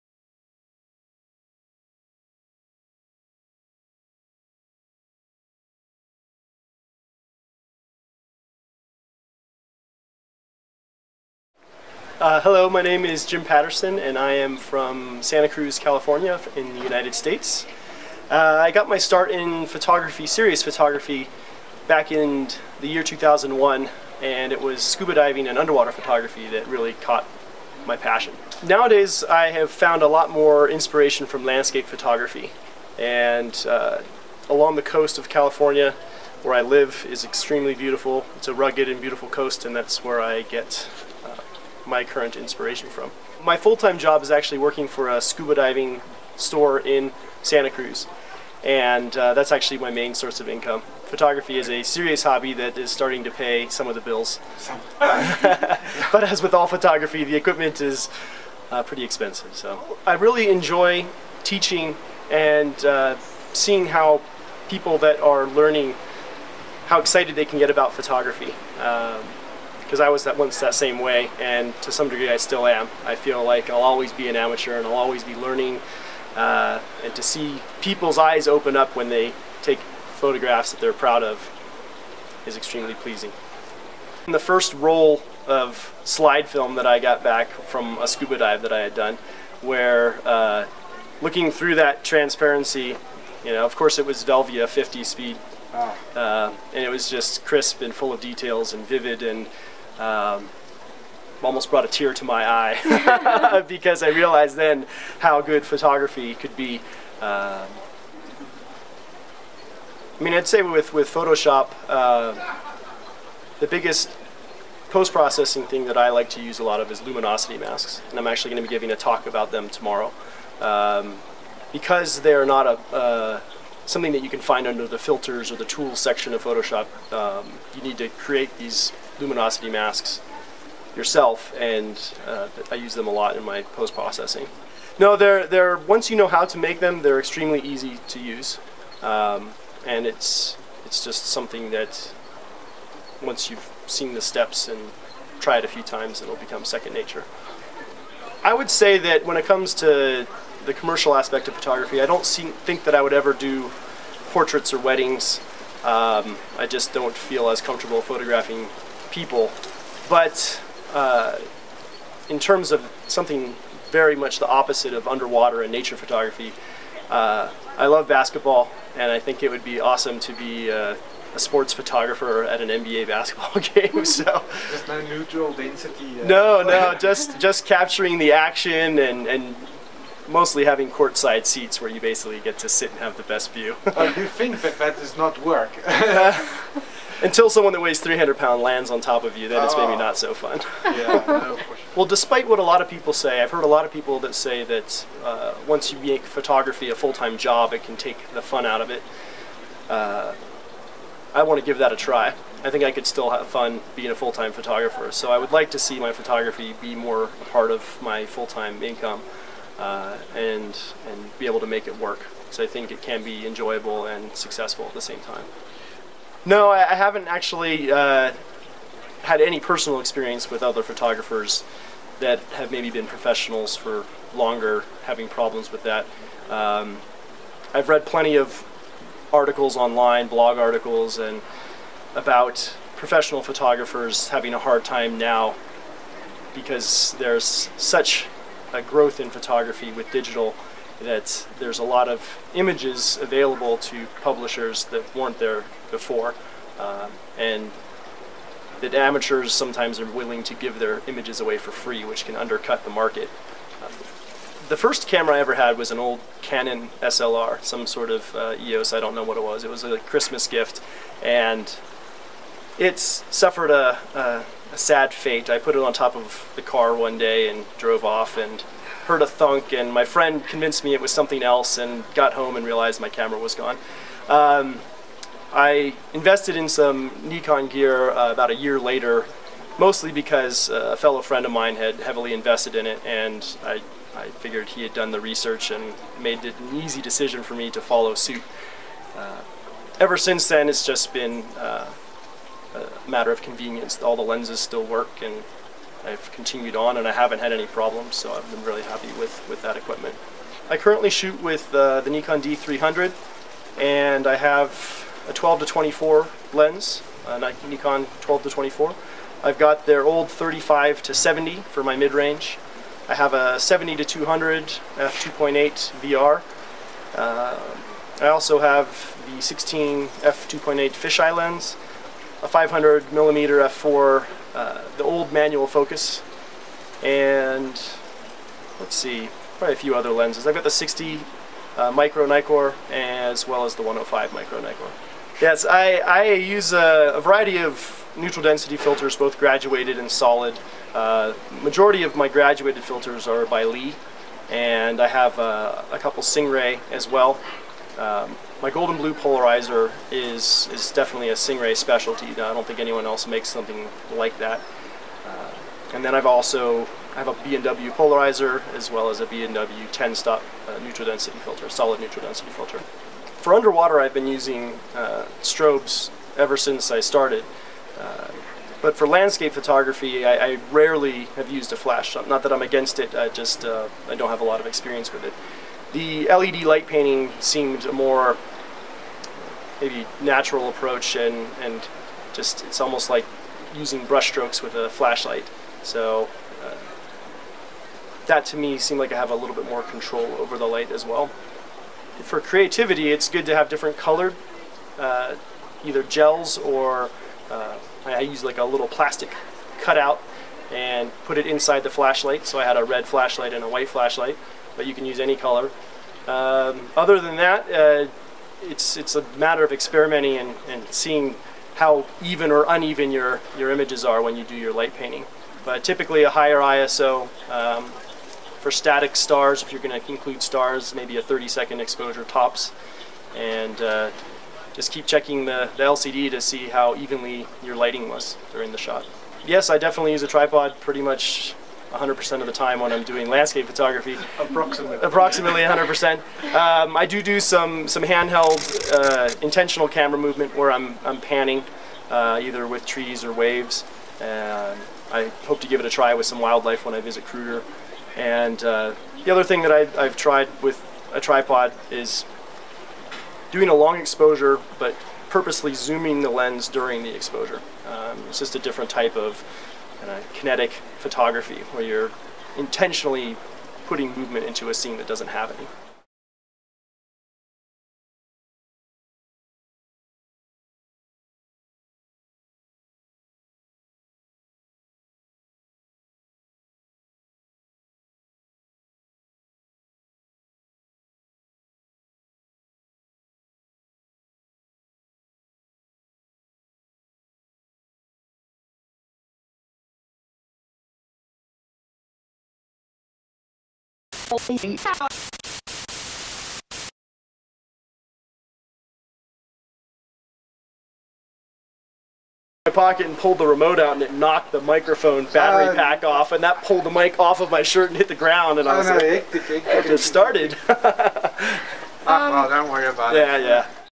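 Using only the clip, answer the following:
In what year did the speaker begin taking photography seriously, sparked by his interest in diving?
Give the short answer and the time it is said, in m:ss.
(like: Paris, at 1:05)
2001, at 0:23.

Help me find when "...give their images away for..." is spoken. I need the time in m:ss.
4:10.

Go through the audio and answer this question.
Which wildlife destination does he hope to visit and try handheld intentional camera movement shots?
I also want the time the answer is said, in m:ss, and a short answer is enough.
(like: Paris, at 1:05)
Kruger, at 7:27.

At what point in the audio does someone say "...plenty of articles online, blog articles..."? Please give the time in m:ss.
3:48.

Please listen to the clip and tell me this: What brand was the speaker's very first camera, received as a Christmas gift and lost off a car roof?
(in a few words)
Canon.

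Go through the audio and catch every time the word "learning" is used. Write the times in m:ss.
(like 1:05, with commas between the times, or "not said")
1:05, 1:15.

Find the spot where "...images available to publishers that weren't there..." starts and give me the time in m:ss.
4:02.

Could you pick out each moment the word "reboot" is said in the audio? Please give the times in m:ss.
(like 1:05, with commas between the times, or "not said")
not said.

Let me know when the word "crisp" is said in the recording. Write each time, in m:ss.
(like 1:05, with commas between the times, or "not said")
1:37.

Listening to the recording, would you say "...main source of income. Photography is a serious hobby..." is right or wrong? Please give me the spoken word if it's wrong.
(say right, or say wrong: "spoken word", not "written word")
right.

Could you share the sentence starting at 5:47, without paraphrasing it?
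Um, my Gold-N-Blue polarizer is is definitely a Singh-Ray specialty.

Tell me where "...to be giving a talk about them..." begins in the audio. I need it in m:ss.
1:58.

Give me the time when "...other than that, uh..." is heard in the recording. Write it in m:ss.
6:46.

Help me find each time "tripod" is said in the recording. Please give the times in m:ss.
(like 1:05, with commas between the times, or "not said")
7:10, 7:31.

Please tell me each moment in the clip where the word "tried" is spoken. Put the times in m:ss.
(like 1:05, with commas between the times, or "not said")
2:25, 7:30.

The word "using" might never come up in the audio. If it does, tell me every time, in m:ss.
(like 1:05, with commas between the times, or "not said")
6:04, 6:23.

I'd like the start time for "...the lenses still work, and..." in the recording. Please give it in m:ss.
4:54.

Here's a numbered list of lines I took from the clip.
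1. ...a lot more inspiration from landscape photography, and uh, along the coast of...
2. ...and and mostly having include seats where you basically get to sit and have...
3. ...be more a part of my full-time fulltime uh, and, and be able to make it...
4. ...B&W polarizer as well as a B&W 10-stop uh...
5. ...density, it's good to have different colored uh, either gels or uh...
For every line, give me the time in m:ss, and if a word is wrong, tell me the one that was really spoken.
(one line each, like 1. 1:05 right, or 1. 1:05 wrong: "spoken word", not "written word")
1. 0:30 right
2. 2:58 wrong: "courtside", not "include"
3. 3:26 wrong: "income", not "fulltime"
4. 5:57 right
5. 6:32 wrong: "creativity", not "density".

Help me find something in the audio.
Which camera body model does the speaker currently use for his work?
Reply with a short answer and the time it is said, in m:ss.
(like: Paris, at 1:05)
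Nikon D300, at 5:02.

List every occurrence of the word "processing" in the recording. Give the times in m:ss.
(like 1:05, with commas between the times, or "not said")
1:54, 2:13.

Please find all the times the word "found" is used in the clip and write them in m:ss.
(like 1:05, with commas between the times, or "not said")
0:29.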